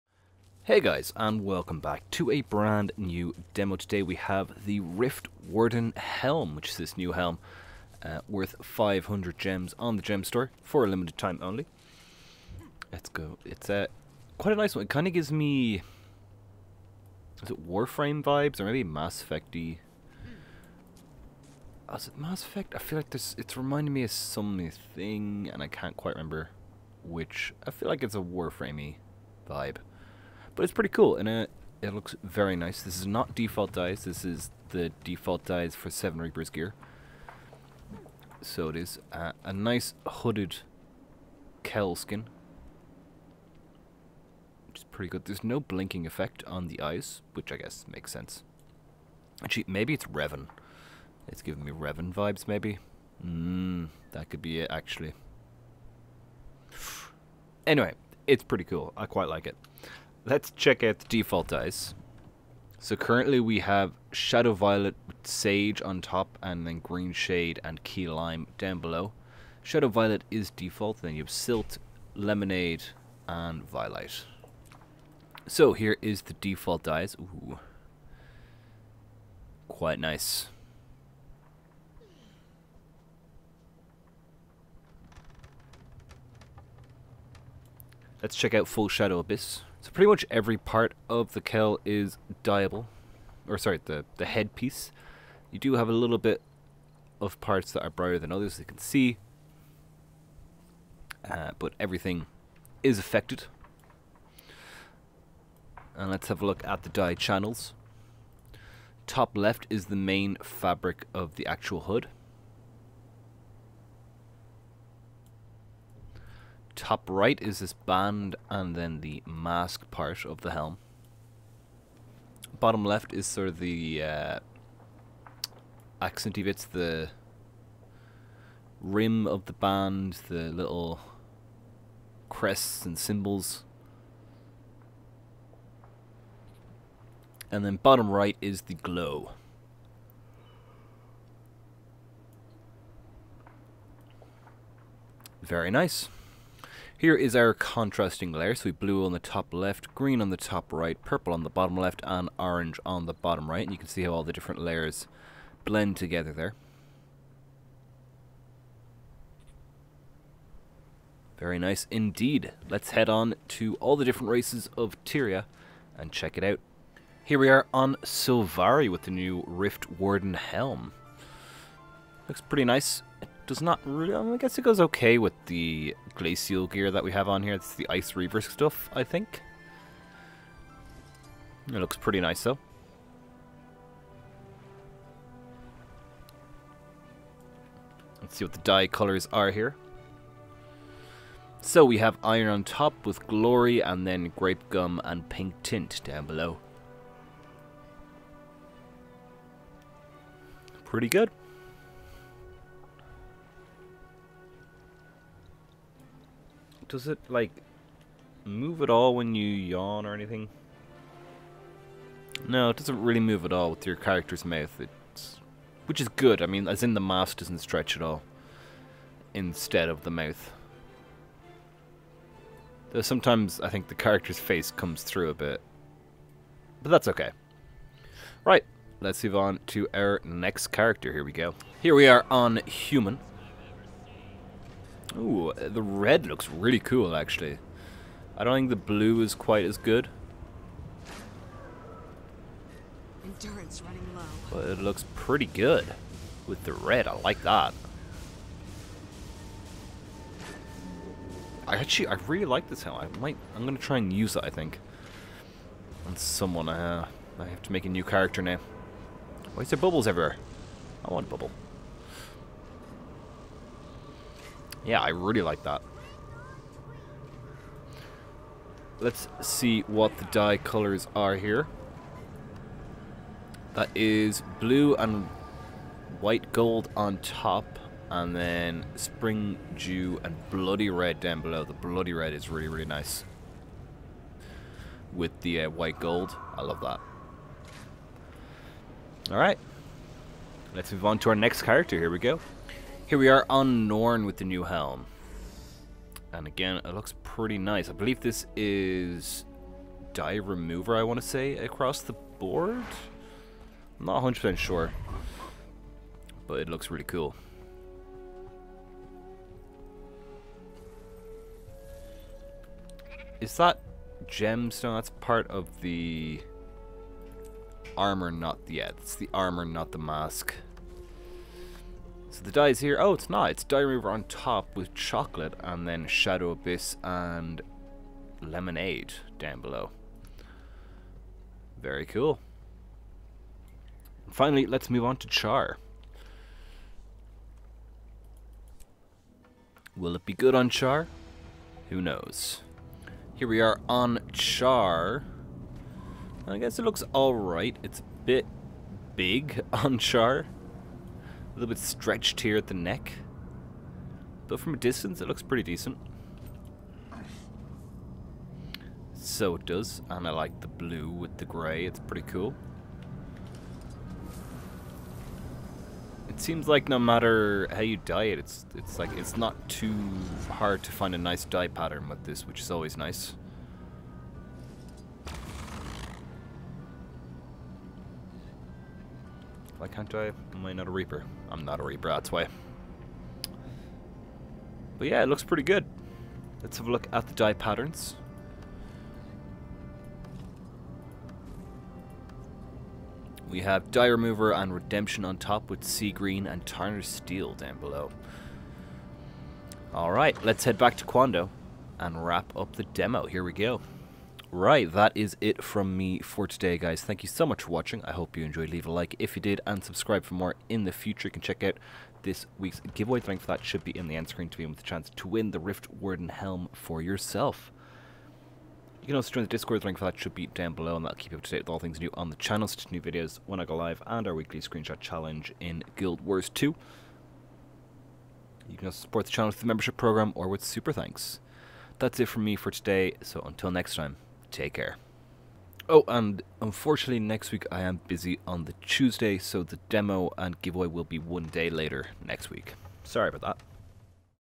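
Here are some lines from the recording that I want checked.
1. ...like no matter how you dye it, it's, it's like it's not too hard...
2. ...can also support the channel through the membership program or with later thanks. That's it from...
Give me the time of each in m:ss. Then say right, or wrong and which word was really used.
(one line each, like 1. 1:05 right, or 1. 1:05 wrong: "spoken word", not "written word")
1. 6:06 right
2. 7:08 wrong: "super", not "later".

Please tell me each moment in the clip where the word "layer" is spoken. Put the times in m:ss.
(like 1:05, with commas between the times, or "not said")
2:28, 2:34.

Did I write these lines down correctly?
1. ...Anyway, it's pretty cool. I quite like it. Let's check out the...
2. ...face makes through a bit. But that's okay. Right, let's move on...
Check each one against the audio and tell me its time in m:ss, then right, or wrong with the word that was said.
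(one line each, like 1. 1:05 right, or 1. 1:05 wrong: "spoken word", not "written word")
1. 0:57 right
2. 3:44 wrong: "comes", not "makes".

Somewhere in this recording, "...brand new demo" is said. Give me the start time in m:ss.
0:02.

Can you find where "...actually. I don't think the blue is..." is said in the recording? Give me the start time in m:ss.
3:57.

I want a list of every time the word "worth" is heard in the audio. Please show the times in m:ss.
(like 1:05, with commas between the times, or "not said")
0:08.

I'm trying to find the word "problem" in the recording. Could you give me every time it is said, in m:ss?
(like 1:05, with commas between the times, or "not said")
not said.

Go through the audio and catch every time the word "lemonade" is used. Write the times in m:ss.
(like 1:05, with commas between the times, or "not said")
1:12, 5:28.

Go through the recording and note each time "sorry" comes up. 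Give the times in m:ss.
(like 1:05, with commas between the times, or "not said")
1:33, 7:23.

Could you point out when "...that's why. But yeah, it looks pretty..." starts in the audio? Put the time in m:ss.
6:22.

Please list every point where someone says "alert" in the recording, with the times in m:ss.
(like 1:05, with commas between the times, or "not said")
not said.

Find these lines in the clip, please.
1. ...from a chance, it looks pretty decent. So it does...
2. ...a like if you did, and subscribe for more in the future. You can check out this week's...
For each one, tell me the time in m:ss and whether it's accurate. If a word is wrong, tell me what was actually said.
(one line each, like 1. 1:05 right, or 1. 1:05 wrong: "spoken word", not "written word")
1. 5:54 wrong: "distance", not "chance"
2. 6:48 right.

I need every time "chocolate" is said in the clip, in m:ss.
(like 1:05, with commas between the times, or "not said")
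5:24.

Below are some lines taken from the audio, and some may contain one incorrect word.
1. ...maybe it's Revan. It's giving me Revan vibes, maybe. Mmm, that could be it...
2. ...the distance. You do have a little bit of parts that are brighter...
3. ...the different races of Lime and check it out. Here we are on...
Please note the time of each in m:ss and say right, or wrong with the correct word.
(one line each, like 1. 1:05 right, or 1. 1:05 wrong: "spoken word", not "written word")
1. 0:49 right
2. 1:34 wrong: "headpiece", not "distance"
3. 2:43 wrong: "Tyria", not "Lime".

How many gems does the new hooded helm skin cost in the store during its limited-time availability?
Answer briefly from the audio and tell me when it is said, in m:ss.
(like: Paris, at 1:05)
500, at 0:08.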